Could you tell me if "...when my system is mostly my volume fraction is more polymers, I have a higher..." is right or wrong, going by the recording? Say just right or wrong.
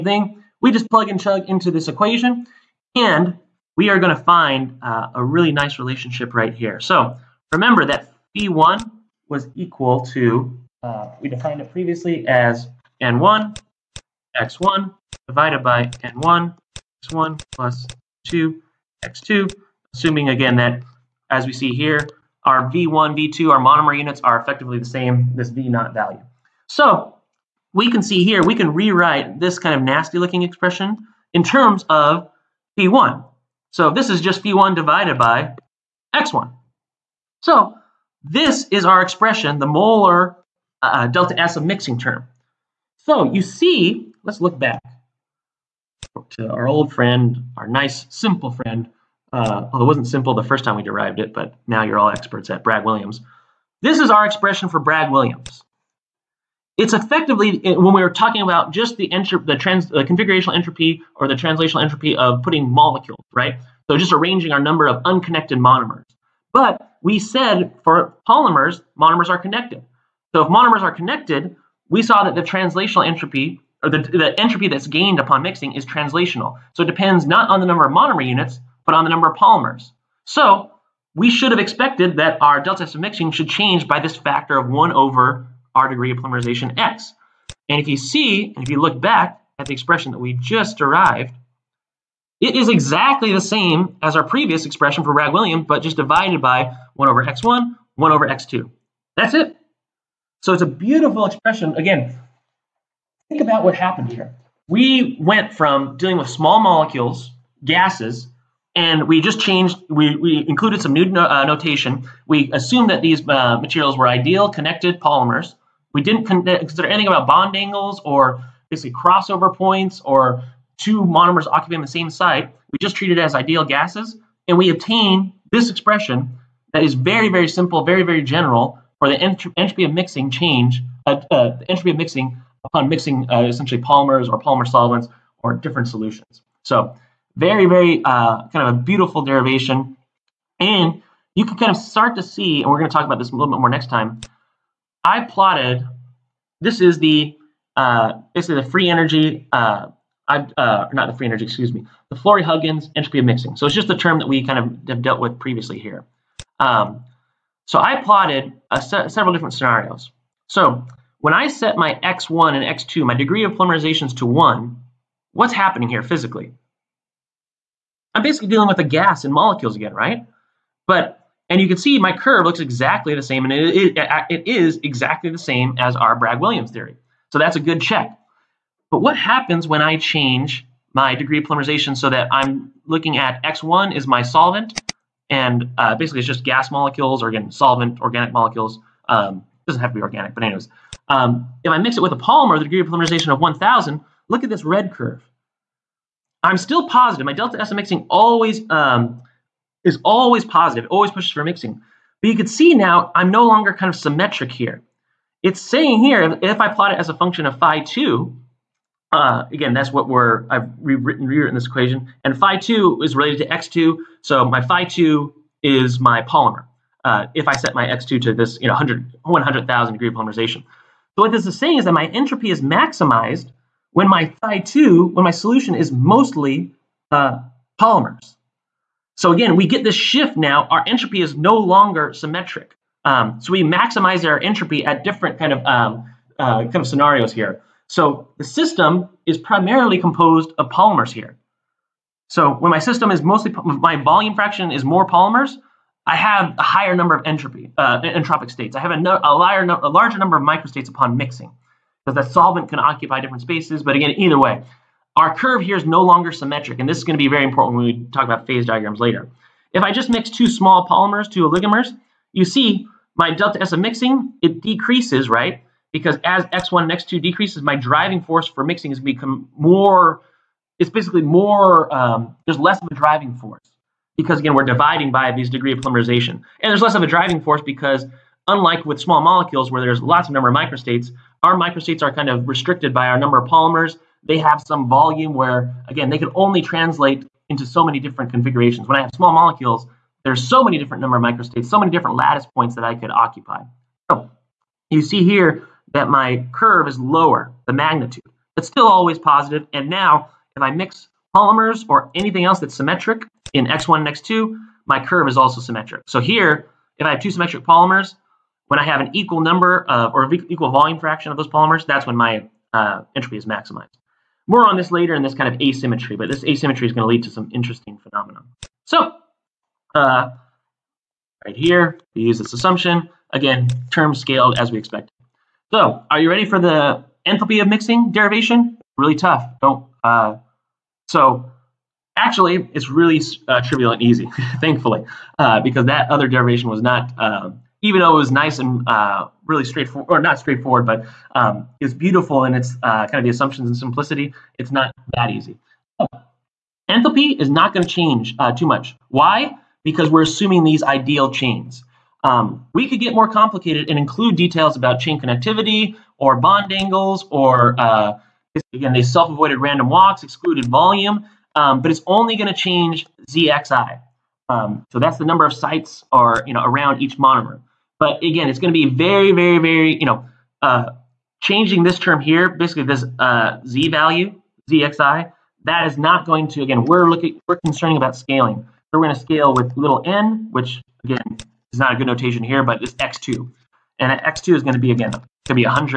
right.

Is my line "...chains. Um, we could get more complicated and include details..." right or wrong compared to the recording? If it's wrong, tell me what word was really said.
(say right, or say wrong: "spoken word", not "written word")
right.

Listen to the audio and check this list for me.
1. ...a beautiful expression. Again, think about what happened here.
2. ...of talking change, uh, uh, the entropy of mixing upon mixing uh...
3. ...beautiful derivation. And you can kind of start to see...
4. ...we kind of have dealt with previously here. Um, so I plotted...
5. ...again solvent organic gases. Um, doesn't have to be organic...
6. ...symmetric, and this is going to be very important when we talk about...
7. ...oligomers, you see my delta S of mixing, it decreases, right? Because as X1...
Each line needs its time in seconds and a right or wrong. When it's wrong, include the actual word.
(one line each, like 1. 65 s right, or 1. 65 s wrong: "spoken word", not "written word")
1. 100 s right
2. 129 s wrong: "mixing", not "talking"
3. 138 s right
4. 154 s right
5. 187 s wrong: "molecules", not "gases"
6. 256 s right
7. 261 s right.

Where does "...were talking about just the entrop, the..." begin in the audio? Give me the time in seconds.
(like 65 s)
58 s.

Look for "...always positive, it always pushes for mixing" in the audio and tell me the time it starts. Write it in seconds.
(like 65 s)
200 s.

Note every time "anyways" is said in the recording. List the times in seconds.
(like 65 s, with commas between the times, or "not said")
190 s.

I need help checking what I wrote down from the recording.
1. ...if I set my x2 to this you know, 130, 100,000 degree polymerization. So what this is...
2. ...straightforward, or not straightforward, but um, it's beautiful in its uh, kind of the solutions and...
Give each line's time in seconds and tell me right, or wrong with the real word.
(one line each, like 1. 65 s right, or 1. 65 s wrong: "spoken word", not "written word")
1. 217 s wrong: "100", not "130"
2. 339 s wrong: "assumptions", not "solutions".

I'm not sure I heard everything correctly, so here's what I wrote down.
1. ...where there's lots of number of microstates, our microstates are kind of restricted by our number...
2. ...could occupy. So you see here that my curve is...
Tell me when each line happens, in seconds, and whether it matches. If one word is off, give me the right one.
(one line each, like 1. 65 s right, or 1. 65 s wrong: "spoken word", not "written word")
1. 279 s right
2. 292 s right.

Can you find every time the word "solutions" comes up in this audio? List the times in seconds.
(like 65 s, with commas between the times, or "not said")
135 s, 225 s.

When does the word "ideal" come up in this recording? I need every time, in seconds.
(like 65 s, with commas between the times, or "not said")
114 s, 123 s, 350 s.